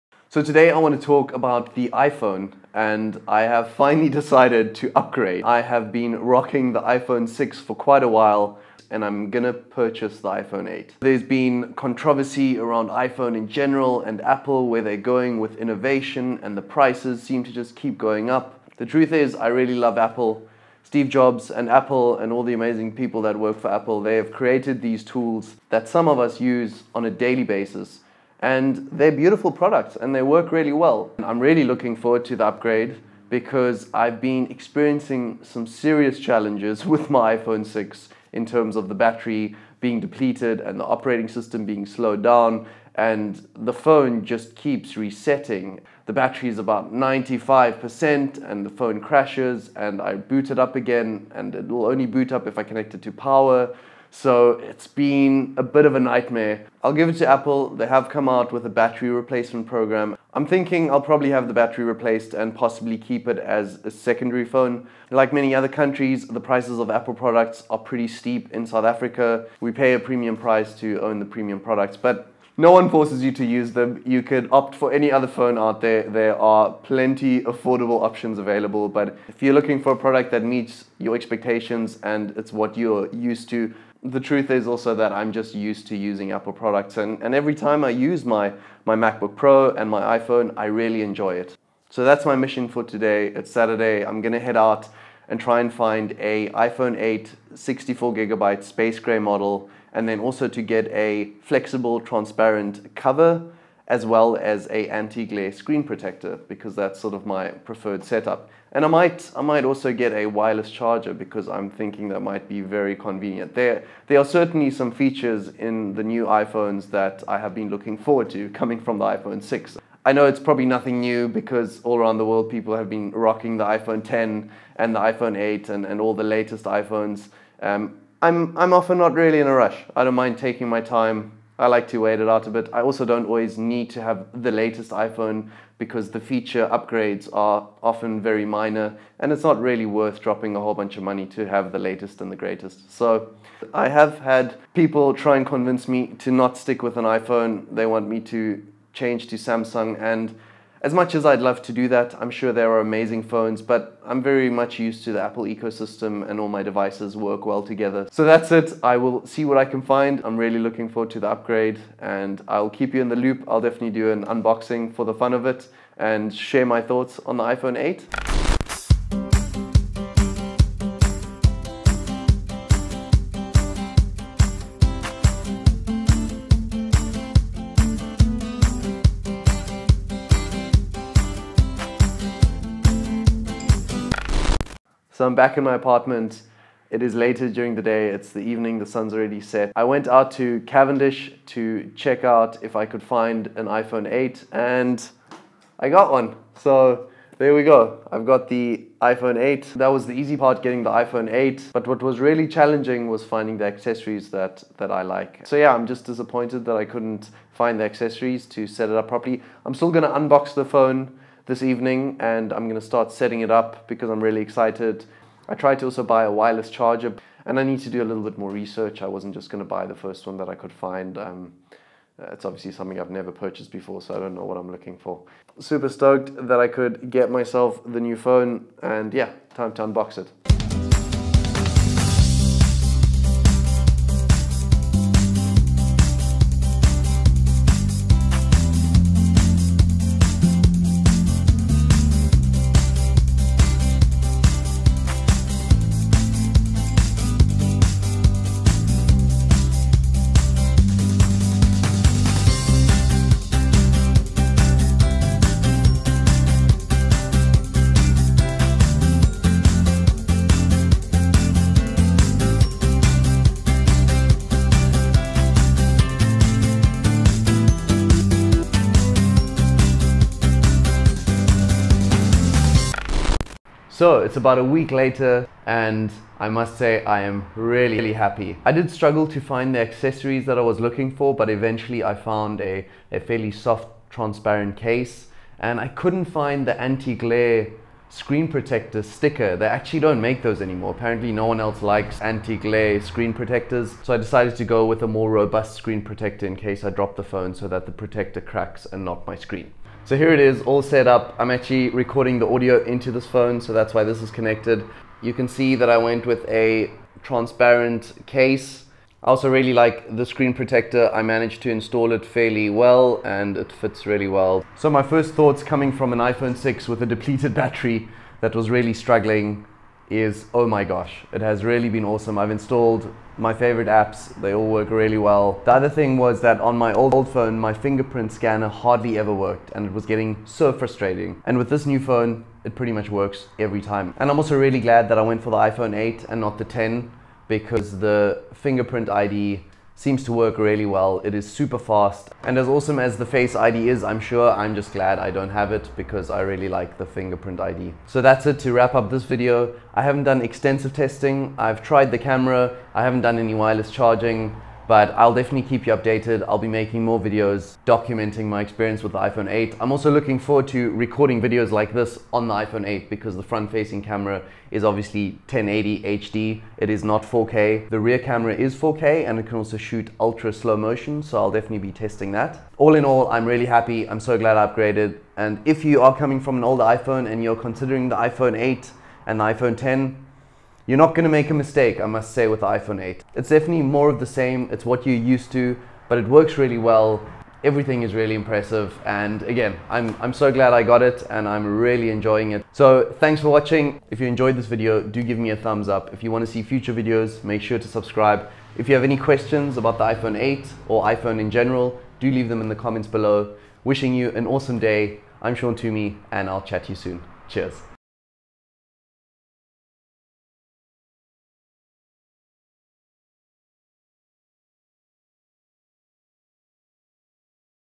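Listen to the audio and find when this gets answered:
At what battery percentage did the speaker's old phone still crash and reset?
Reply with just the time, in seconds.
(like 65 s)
46 s.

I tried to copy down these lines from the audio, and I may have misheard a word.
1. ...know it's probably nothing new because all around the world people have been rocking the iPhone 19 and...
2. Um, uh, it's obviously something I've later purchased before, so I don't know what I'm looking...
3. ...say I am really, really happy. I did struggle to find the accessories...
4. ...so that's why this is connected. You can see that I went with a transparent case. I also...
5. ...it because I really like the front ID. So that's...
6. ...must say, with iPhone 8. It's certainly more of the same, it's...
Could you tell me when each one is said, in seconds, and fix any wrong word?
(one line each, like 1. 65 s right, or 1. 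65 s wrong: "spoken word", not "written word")
1. 120 s wrong: "10", not "19"
2. 221 s wrong: "never", not "later"
3. 276 s right
4. 303 s right
5. 345 s wrong: "fingerprint", not "front"
6. 382 s wrong: "definitely", not "certainly".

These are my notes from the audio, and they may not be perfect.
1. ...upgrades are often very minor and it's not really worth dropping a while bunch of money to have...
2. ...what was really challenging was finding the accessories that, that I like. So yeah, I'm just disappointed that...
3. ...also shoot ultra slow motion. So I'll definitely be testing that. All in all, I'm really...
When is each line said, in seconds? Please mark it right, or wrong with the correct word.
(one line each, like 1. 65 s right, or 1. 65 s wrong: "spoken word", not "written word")
1. 136 s wrong: "whole", not "while"
2. 201 s right
3. 369 s right.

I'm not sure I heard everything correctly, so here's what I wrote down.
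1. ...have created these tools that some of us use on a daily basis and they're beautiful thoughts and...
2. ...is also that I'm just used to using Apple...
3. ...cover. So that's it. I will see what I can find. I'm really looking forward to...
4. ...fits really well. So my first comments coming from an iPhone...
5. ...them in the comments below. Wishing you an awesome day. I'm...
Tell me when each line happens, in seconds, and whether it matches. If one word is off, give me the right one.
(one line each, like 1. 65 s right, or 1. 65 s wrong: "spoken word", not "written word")
1. 24 s wrong: "products", not "thoughts"
2. 84 s right
3. 157 s wrong: "together", not "cover"
4. 313 s wrong: "thoughts", not "comments"
5. 402 s right.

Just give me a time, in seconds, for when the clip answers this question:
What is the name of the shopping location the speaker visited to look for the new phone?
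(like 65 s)
190 s.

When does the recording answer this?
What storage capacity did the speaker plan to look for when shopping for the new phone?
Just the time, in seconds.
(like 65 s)
97 s.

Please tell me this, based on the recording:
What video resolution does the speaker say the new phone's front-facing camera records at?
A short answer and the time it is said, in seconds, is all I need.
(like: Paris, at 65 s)
1080 HD, at 365 s.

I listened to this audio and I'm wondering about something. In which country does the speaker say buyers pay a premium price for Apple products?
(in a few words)
South Africa.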